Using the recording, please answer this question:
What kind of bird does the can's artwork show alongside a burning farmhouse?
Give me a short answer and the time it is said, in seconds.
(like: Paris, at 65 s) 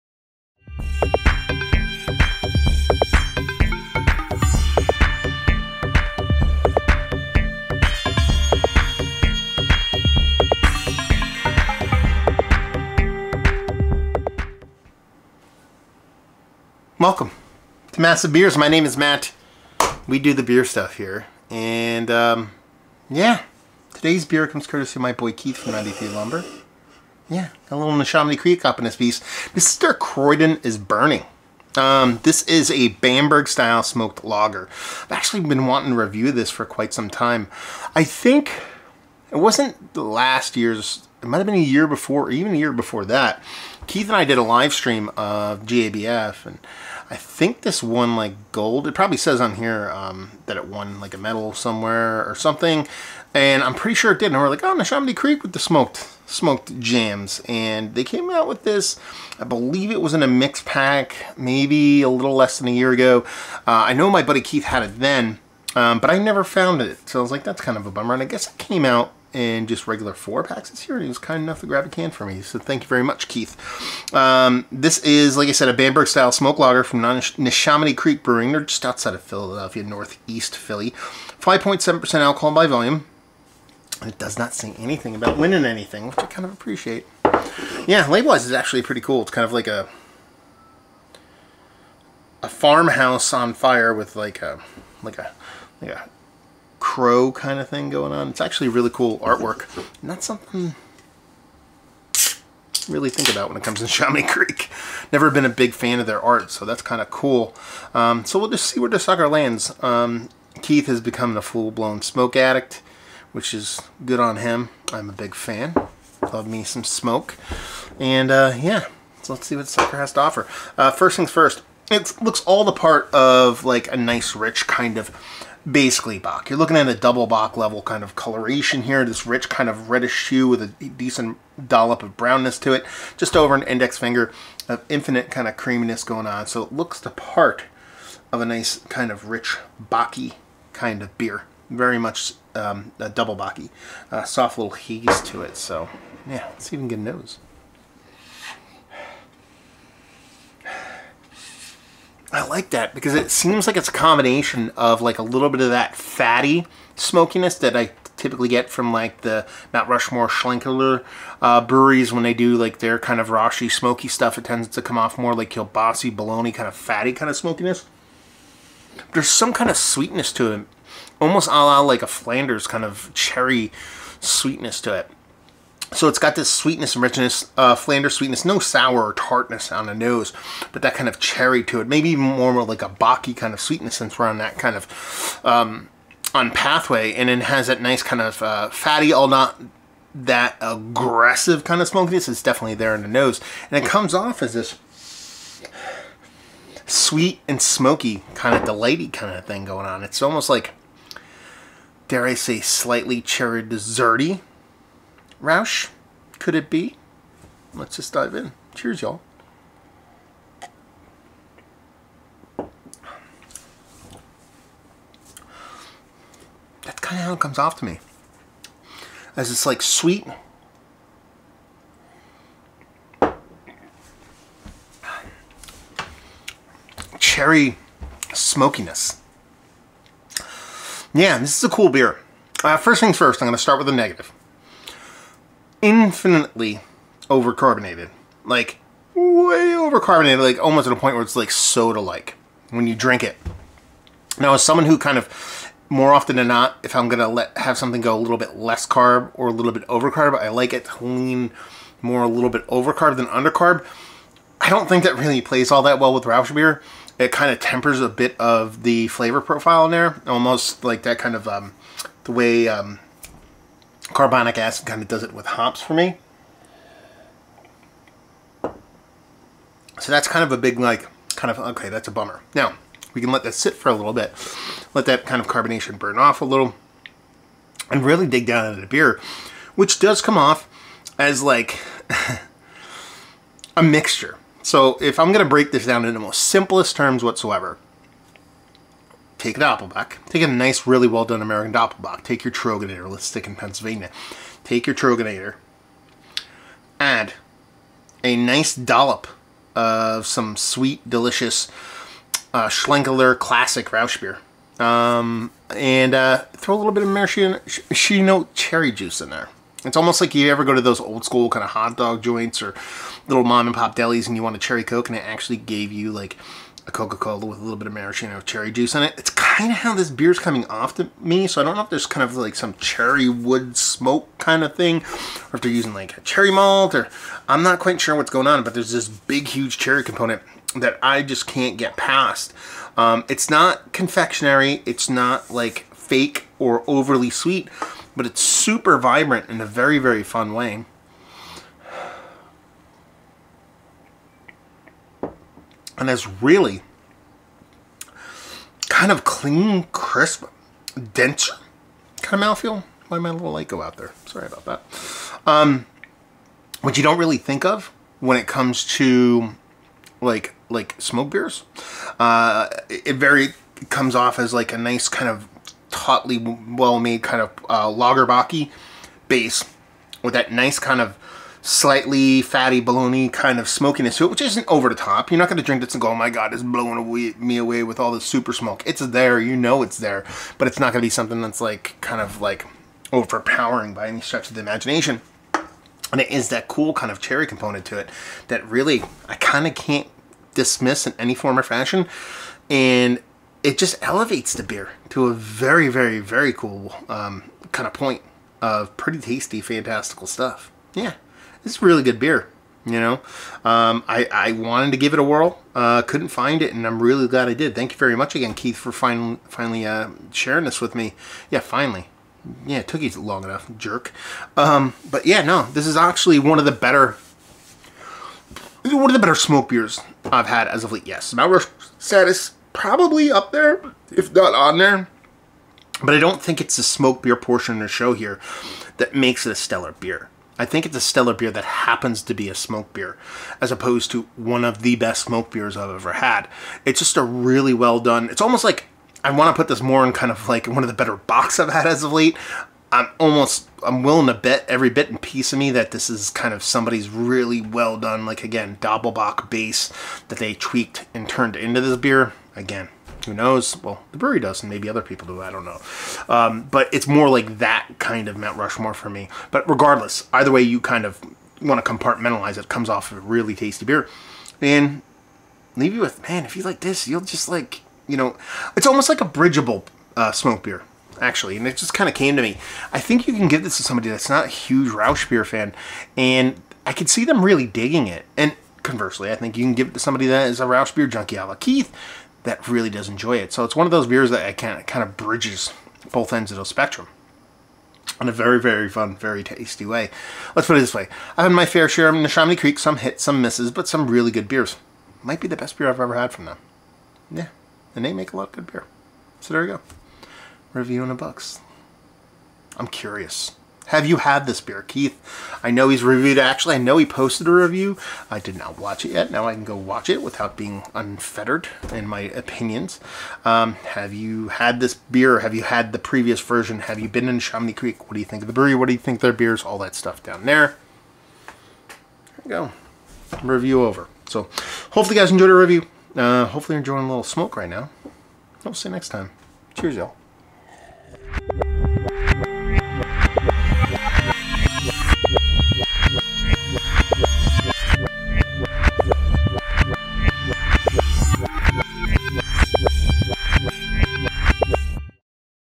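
A crow, at 96 s.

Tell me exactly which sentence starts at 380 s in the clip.
But it's not going to be something that's like kind of like overpowering by any stretch of the imagination.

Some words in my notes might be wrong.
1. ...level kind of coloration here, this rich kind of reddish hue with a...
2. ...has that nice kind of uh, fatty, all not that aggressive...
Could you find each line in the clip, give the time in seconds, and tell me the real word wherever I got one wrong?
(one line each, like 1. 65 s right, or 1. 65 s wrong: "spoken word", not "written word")
1. 127 s right
2. 187 s right.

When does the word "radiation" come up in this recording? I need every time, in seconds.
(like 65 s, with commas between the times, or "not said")
not said.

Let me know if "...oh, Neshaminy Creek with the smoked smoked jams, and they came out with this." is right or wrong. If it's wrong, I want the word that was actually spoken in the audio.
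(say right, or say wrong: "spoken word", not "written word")
right.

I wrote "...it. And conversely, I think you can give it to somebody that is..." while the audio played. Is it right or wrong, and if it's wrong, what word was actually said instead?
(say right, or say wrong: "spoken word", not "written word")
right.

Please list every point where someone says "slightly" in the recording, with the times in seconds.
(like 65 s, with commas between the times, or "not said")
202 s, 371 s.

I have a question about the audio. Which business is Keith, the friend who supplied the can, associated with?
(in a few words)
93 Lumber.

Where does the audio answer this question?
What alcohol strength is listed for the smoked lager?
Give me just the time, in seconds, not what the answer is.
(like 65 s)
80 s.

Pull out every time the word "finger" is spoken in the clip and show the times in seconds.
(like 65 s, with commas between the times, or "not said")
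133 s.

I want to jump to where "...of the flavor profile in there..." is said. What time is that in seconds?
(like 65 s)
258 s.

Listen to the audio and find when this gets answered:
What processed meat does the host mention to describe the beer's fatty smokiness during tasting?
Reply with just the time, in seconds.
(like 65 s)
372 s.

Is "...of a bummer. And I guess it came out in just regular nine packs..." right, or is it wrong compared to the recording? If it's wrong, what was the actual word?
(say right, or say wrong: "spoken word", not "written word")
wrong: "four", not "nine".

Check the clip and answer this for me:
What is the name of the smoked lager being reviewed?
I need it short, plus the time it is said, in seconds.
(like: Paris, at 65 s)
Croydon is Burning, at 29 s.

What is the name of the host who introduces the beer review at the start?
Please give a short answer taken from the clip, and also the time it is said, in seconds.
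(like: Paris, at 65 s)
Matt, at 18 s.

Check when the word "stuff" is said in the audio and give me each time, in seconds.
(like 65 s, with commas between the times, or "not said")
20 s, 164 s, 400 s, 519 s.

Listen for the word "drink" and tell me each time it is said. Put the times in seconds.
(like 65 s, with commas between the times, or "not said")
242 s, 375 s.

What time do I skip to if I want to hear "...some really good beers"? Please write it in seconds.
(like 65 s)
493 s.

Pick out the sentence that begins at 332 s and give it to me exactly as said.
Um, it's not confectionery, it's not like fake or overly sweet, but it's super vibrant in a very, very fun way.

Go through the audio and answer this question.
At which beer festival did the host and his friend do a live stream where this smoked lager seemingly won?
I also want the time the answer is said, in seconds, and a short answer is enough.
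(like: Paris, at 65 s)
GABF, at 45 s.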